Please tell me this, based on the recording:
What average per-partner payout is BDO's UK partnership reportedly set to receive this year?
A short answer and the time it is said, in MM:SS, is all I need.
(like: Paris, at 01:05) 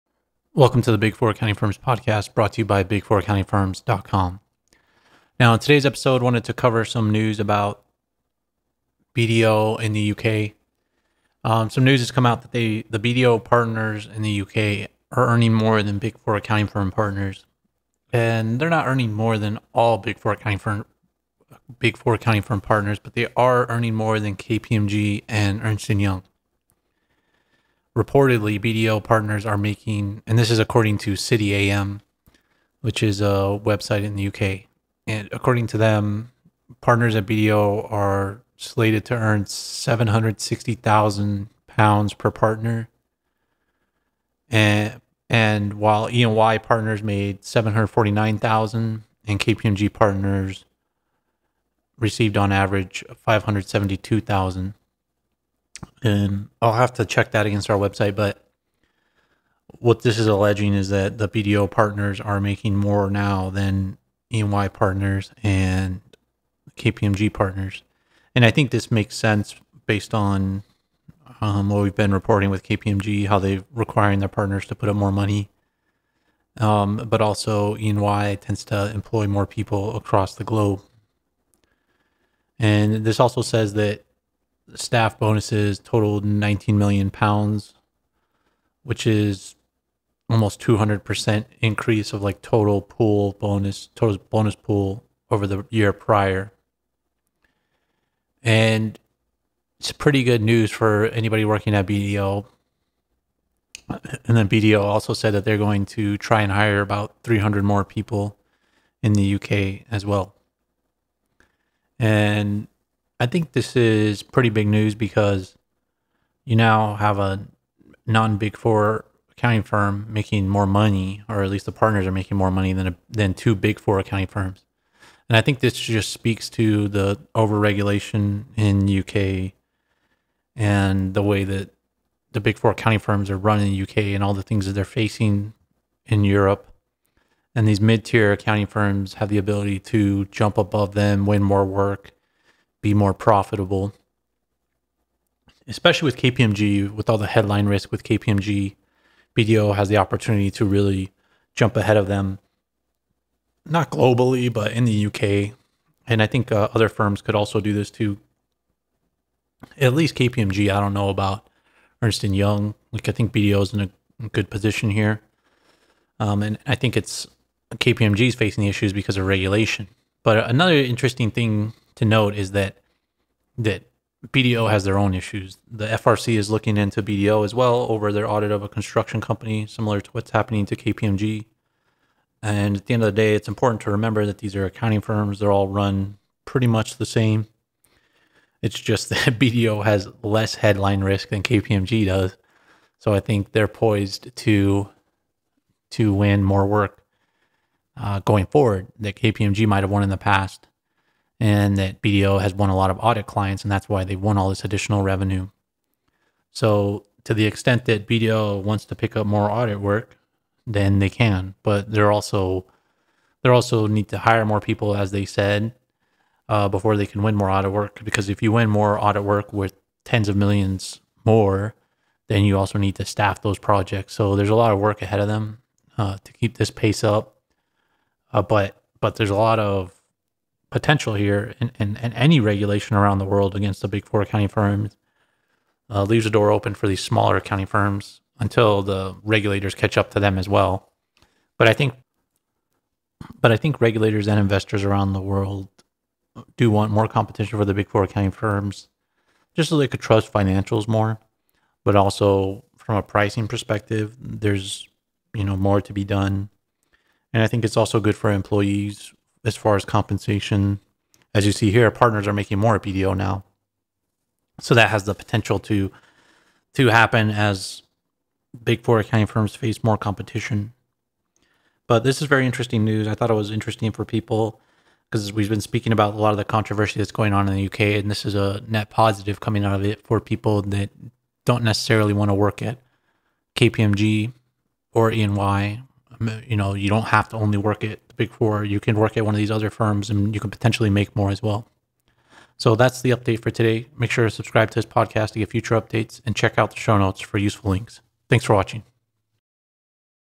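£760,000, at 00:39.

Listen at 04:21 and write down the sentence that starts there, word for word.
As you see here, partners are making more at BDO now.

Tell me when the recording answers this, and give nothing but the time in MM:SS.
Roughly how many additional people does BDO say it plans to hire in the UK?
01:47.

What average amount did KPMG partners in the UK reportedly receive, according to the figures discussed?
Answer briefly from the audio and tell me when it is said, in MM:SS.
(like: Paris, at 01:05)
£572,000, at 00:53.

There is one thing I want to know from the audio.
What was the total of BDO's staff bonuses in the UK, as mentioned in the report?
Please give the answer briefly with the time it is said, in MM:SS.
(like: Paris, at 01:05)
19 million pounds, at 01:26.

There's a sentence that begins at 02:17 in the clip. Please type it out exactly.
And these mid tier accounting firms have the ability to jump above them, win more work, be more profitable.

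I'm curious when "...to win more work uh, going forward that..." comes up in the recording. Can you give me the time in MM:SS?
03:15.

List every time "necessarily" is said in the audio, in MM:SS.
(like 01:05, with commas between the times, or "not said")
04:41.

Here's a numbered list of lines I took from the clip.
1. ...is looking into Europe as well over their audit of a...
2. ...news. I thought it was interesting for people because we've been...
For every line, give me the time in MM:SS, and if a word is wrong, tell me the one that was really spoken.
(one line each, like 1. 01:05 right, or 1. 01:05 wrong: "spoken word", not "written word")
1. 02:56 wrong: "BDO", not "Europe"
2. 04:32 right.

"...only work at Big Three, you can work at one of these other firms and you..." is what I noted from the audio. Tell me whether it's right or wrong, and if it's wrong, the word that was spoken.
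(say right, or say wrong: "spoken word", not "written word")
wrong: "Four", not "Three".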